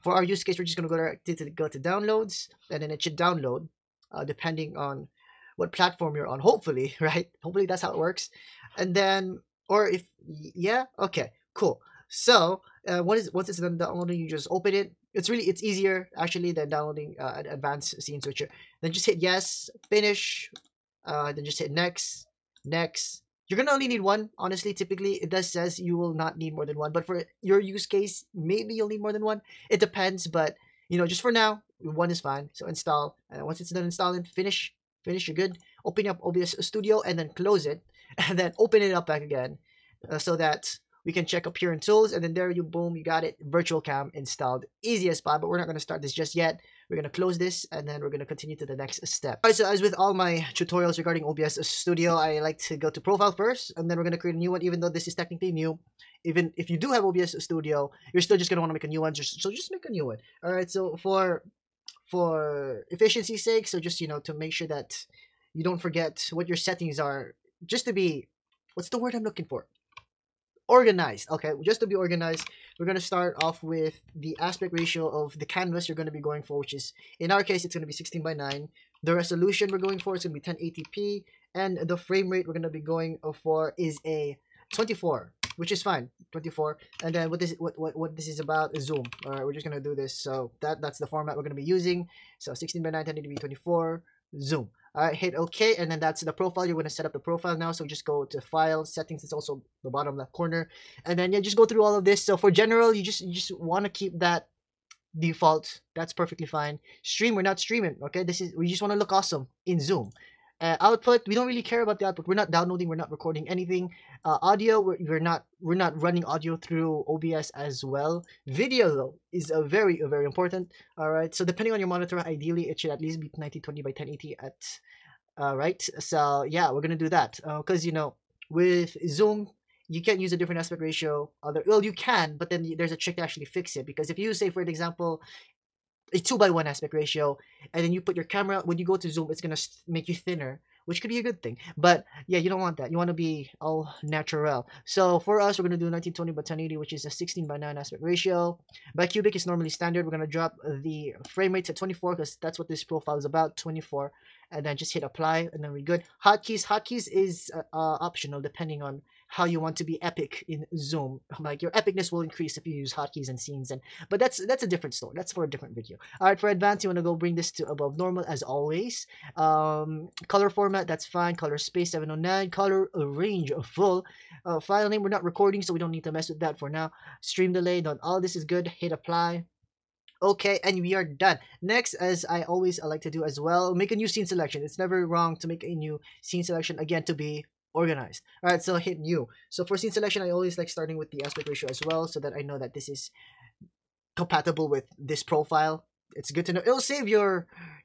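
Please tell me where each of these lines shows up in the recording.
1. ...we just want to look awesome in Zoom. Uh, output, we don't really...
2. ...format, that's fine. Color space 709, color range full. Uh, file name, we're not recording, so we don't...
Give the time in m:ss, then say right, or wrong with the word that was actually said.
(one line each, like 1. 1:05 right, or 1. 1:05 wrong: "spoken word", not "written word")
1. 1:48 right
2. 2:50 right.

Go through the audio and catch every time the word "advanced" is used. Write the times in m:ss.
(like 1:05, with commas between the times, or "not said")
0:17, 2:46.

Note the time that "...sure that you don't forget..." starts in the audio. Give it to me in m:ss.
1:04.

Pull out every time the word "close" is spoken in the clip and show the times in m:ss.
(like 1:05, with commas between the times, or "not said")
0:37, 0:47.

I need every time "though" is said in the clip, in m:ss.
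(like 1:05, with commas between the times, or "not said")
0:54, 1:58.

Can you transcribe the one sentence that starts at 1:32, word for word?
So 16 by 9, 1080p, 24, zoom.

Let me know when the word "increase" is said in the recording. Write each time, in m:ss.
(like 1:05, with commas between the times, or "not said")
2:42.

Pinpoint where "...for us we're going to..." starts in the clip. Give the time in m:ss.
2:25.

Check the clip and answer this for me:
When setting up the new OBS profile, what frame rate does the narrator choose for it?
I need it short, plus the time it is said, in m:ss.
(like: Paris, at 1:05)
24, at 1:24.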